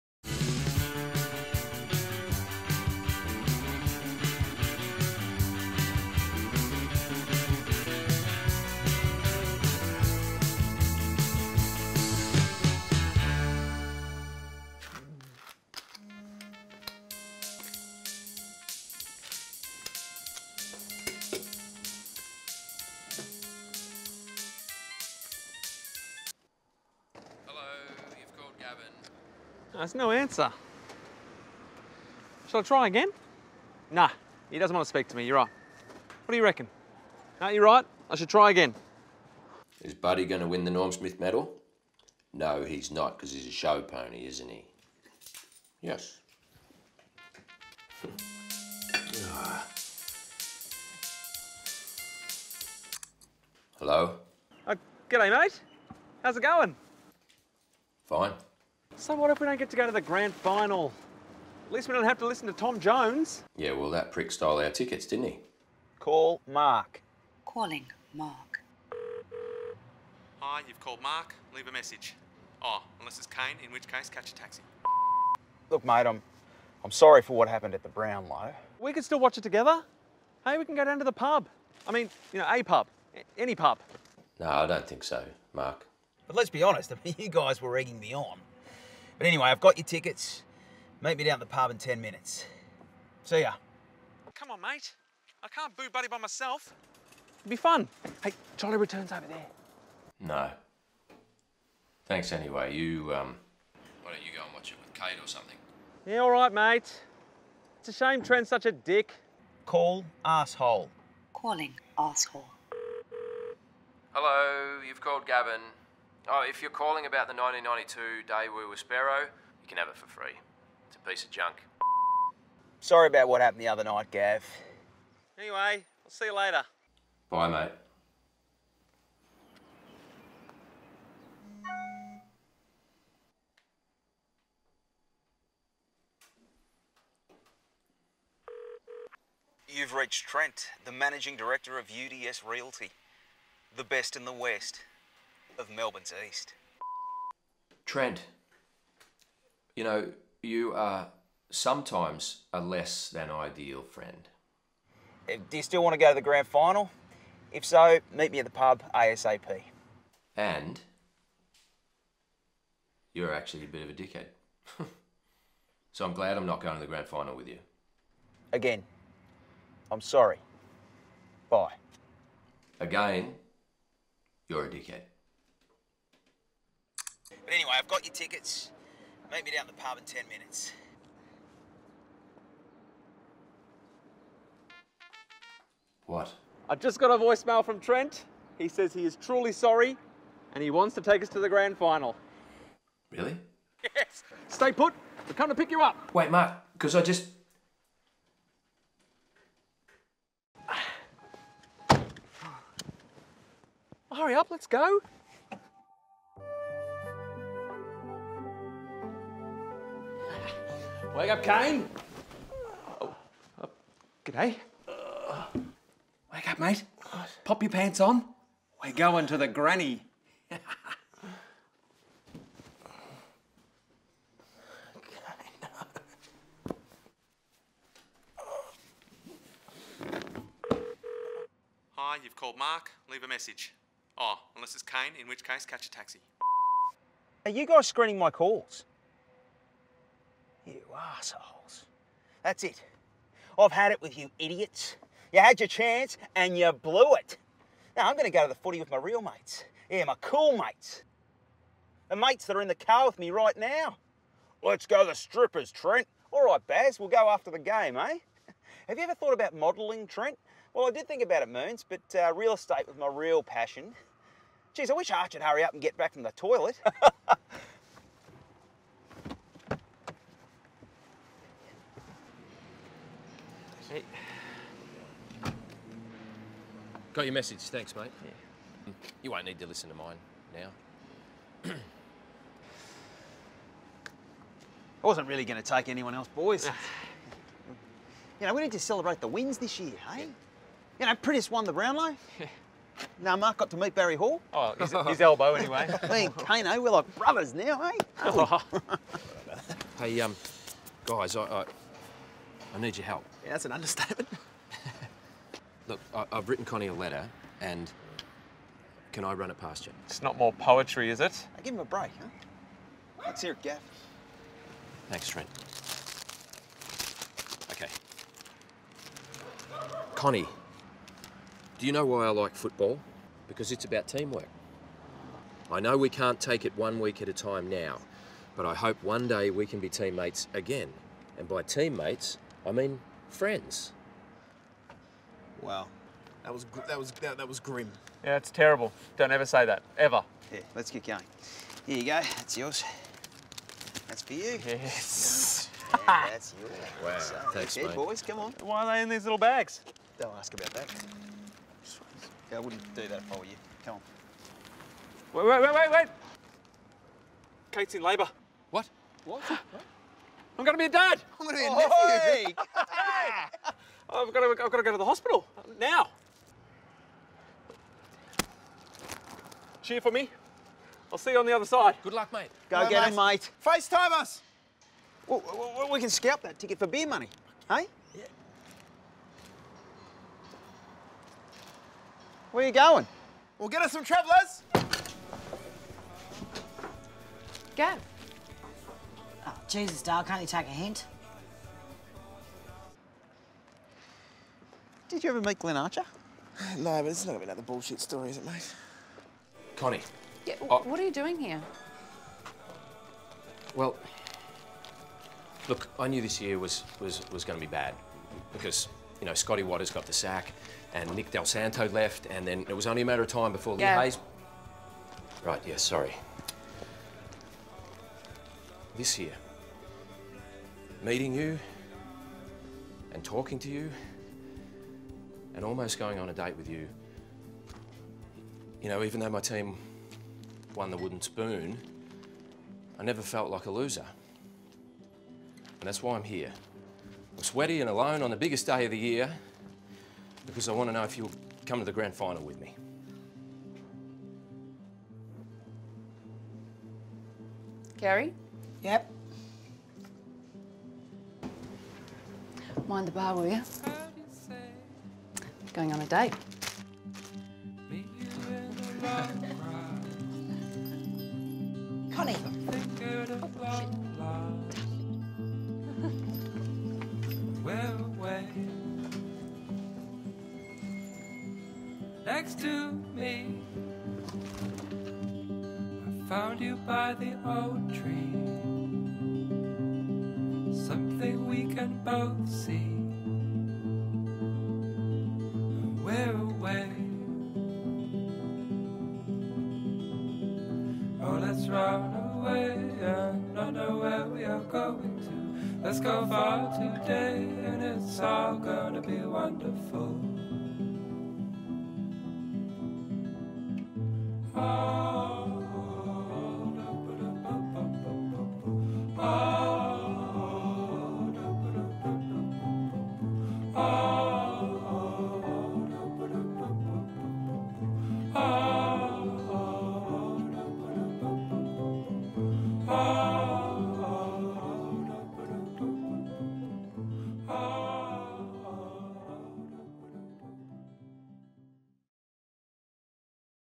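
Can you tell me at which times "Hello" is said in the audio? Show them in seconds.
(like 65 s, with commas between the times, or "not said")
53 s, 114 s, 372 s.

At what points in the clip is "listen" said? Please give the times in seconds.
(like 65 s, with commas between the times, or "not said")
62 s, 279 s.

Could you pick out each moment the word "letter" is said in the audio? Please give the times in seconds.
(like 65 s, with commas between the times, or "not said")
306 s.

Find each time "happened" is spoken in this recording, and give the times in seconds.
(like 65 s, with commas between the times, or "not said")
77 s, 123 s.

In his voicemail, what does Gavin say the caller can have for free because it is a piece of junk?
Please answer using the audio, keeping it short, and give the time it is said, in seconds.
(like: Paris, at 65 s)
The 1992 Sparrow, at 117 s.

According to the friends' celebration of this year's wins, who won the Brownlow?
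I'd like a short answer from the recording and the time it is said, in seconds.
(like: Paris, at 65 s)
Priddis, at 291 s.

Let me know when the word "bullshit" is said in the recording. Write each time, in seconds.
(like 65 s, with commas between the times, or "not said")
397 s.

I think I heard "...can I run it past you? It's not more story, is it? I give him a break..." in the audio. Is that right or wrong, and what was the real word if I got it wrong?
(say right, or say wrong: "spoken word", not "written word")
wrong: "poetry", not "story".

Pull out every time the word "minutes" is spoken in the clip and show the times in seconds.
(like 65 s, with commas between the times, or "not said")
92 s, 180 s.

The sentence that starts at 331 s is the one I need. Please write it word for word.
And by teammates, I mean, friends.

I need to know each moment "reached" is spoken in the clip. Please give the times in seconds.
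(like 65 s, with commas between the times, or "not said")
139 s.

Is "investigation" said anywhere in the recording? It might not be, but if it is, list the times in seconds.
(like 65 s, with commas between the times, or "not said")
not said.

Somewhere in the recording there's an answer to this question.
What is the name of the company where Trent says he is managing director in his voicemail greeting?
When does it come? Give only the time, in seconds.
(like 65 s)
141 s.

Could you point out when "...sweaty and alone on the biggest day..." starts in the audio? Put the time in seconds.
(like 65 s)
437 s.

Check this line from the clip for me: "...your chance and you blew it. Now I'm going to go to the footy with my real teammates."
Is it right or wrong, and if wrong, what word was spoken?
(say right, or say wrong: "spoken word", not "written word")
wrong: "mates", not "teammates".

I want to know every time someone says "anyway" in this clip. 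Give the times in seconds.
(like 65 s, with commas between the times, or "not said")
89 s, 102 s, 125 s, 177 s, 295 s.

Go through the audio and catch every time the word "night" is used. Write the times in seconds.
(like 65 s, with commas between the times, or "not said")
123 s.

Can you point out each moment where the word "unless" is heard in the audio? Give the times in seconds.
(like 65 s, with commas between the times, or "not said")
72 s, 234 s.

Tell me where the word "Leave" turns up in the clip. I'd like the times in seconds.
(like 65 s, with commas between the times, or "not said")
71 s, 233 s.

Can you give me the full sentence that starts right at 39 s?
Is Buddy going to win the Norm Smith medal?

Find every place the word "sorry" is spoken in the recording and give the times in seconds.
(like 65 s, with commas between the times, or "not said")
76 s, 122 s, 170 s, 189 s, 415 s.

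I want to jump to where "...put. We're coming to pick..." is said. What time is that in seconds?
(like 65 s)
194 s.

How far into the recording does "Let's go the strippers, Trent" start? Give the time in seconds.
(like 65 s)
254 s.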